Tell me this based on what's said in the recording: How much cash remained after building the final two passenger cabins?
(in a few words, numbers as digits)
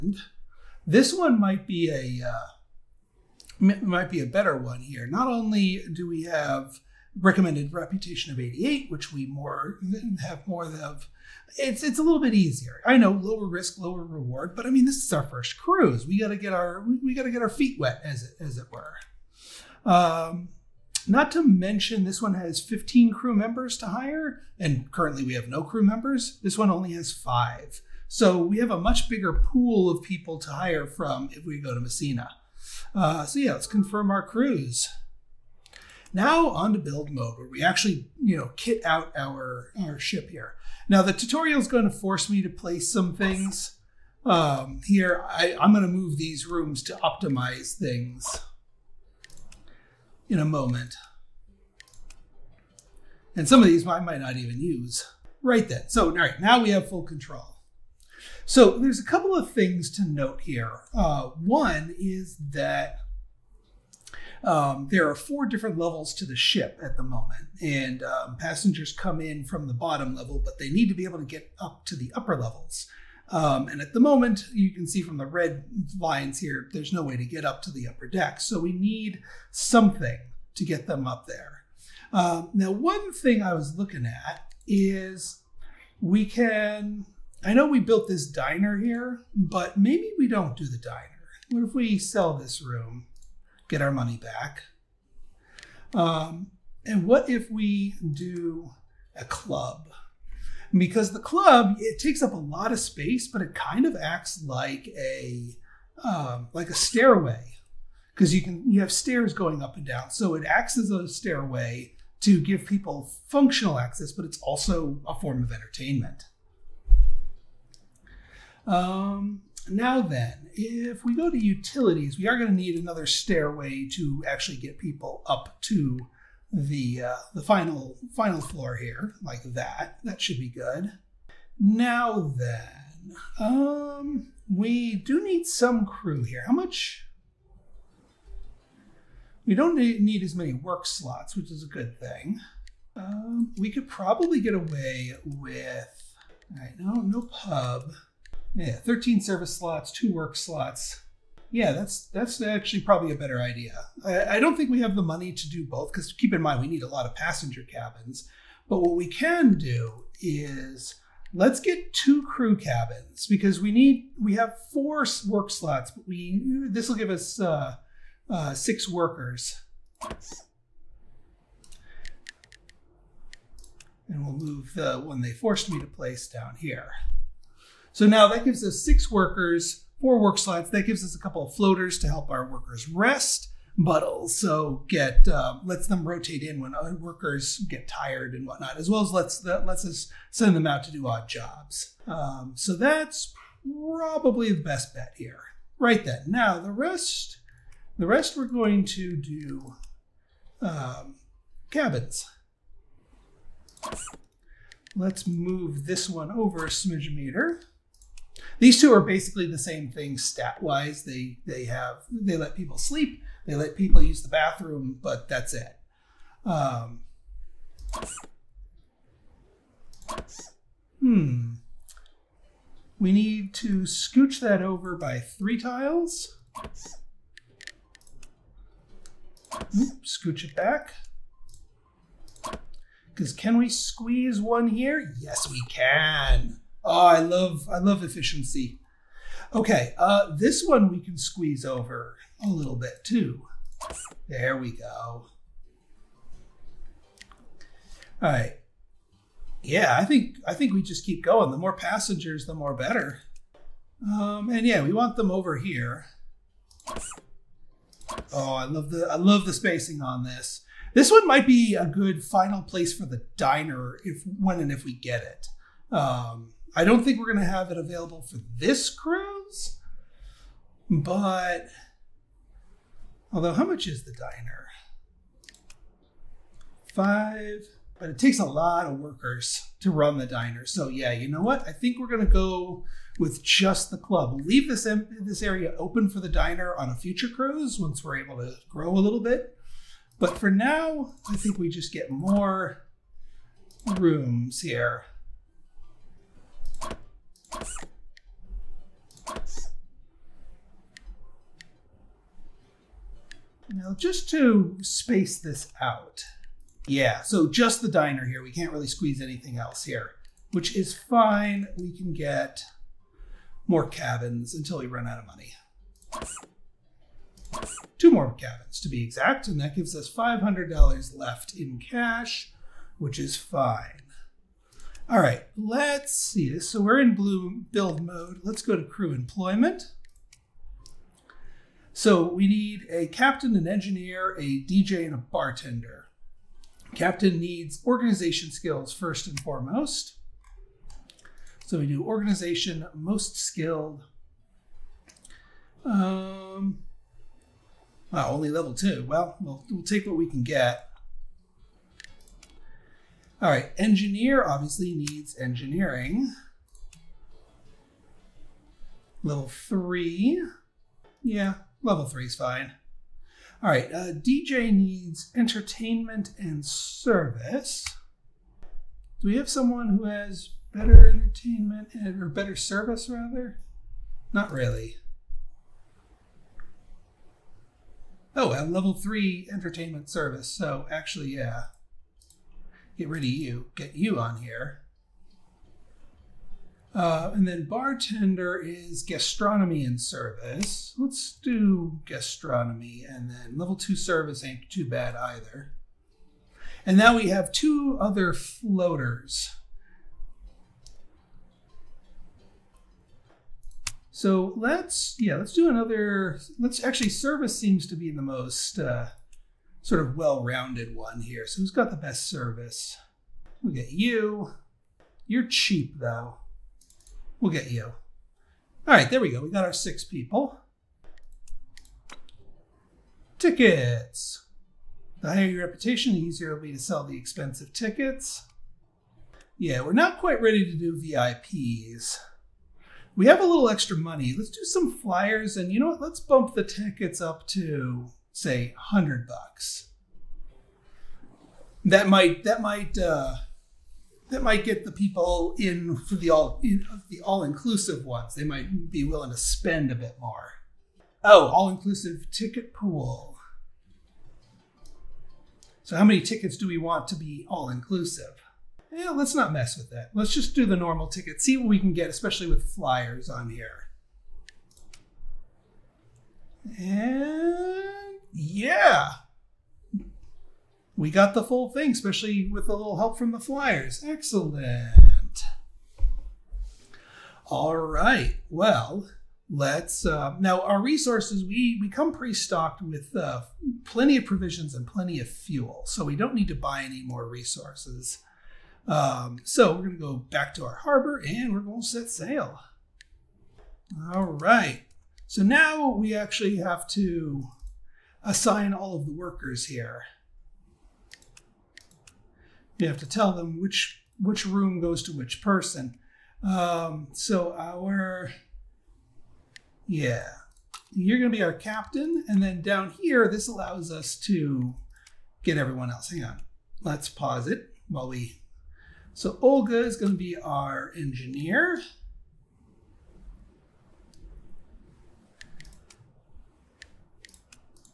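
$500.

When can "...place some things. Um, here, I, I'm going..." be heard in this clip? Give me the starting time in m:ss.
0:42.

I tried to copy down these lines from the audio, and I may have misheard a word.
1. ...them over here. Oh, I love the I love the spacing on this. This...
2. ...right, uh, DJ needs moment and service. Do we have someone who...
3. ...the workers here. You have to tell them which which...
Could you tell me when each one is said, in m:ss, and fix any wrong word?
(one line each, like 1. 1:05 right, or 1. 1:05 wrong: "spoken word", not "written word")
1. 4:15 right
2. 6:03 wrong: "entertainment", not "moment"
3. 8:19 right.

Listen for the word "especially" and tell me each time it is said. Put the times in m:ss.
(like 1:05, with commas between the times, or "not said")
7:42, 7:51.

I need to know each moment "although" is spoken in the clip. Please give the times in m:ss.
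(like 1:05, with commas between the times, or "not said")
4:33.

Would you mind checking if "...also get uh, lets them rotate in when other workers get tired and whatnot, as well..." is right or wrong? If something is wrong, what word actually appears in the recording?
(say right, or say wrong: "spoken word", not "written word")
right.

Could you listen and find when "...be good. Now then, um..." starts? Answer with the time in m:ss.
2:10.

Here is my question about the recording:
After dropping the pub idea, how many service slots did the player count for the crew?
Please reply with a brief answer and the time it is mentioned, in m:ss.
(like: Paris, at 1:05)
13, at 2:28.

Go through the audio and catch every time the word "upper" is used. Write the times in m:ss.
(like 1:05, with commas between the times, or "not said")
1:12, 1:17.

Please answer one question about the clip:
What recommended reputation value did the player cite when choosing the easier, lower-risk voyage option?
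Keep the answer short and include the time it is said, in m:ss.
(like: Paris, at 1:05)
88, at 0:08.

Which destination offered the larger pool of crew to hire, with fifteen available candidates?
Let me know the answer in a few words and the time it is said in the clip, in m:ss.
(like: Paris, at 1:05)
Messina, at 0:31.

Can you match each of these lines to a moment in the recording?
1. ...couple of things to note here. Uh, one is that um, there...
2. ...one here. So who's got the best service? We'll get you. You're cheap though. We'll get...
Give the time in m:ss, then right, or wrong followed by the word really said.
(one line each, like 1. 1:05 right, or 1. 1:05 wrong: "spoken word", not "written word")
1. 0:59 right
2. 6:50 right.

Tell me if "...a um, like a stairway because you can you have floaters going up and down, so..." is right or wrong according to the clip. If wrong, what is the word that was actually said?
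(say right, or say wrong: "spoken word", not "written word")
wrong: "stairs", not "floaters".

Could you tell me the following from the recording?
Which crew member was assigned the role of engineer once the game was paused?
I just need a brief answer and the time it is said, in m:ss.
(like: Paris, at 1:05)
Olga, at 8:39.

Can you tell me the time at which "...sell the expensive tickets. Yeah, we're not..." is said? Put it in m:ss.
7:06.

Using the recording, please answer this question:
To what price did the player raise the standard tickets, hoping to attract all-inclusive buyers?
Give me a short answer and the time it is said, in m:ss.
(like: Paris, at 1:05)
$100, at 7:18.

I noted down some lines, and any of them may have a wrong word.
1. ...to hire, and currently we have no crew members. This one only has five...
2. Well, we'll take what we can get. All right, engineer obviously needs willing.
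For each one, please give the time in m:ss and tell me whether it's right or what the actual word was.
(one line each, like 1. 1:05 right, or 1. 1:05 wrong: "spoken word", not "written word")
1. 0:23 right
2. 5:49 wrong: "engineering", not "willing".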